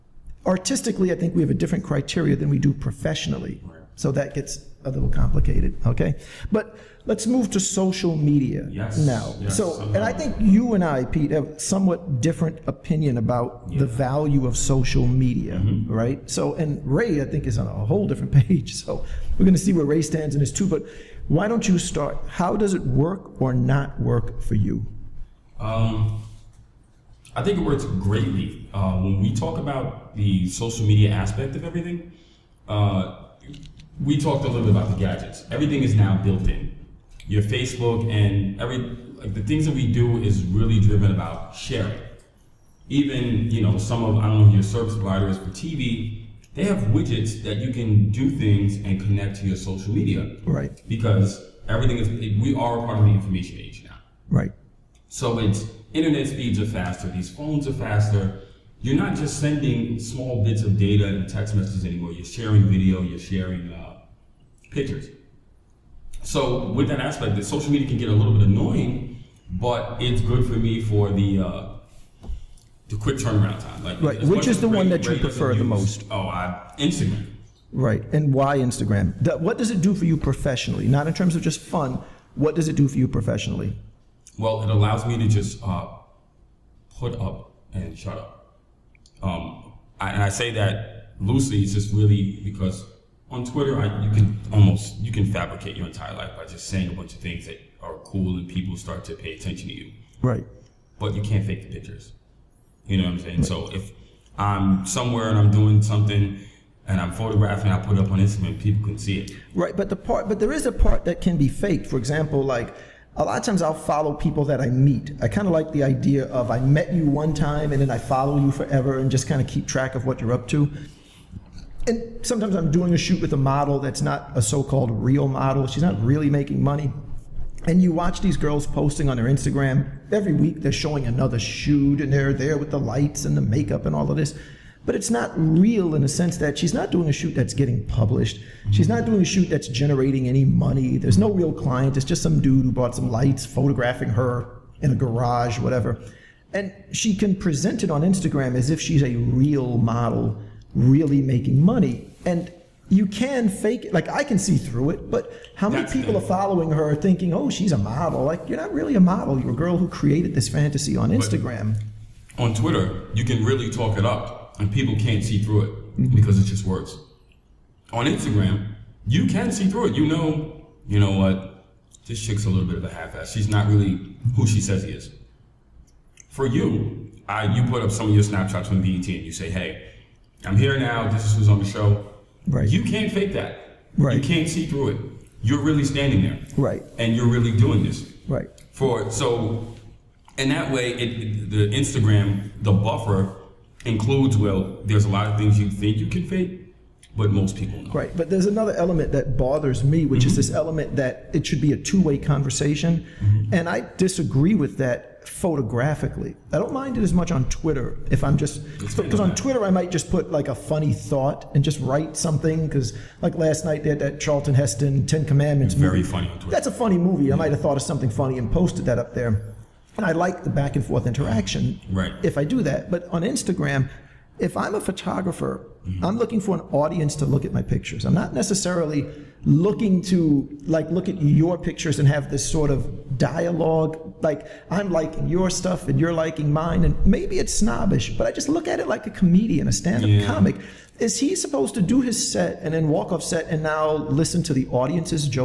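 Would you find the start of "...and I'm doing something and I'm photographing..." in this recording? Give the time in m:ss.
1:45.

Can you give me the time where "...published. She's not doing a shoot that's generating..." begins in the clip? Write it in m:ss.
2:17.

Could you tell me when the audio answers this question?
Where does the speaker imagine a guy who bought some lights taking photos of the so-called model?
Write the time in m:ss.
2:23.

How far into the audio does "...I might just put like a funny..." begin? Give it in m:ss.
3:29.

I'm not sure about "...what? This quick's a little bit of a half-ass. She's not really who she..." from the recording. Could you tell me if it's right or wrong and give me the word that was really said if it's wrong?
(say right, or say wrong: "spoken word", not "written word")
wrong: "chick", not "quick".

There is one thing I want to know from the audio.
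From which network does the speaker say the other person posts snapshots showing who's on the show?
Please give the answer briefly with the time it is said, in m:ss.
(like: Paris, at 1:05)
BET, at 2:58.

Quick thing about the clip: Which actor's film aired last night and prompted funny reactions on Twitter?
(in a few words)
Charlton Heston.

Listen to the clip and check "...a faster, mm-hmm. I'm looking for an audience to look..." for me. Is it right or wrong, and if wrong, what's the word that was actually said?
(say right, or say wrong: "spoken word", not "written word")
wrong: "photographer", not "faster".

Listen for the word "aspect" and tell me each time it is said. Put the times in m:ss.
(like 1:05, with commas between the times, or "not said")
0:31, 1:06.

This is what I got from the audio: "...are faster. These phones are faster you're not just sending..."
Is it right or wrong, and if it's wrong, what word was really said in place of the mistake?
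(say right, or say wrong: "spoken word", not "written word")
right.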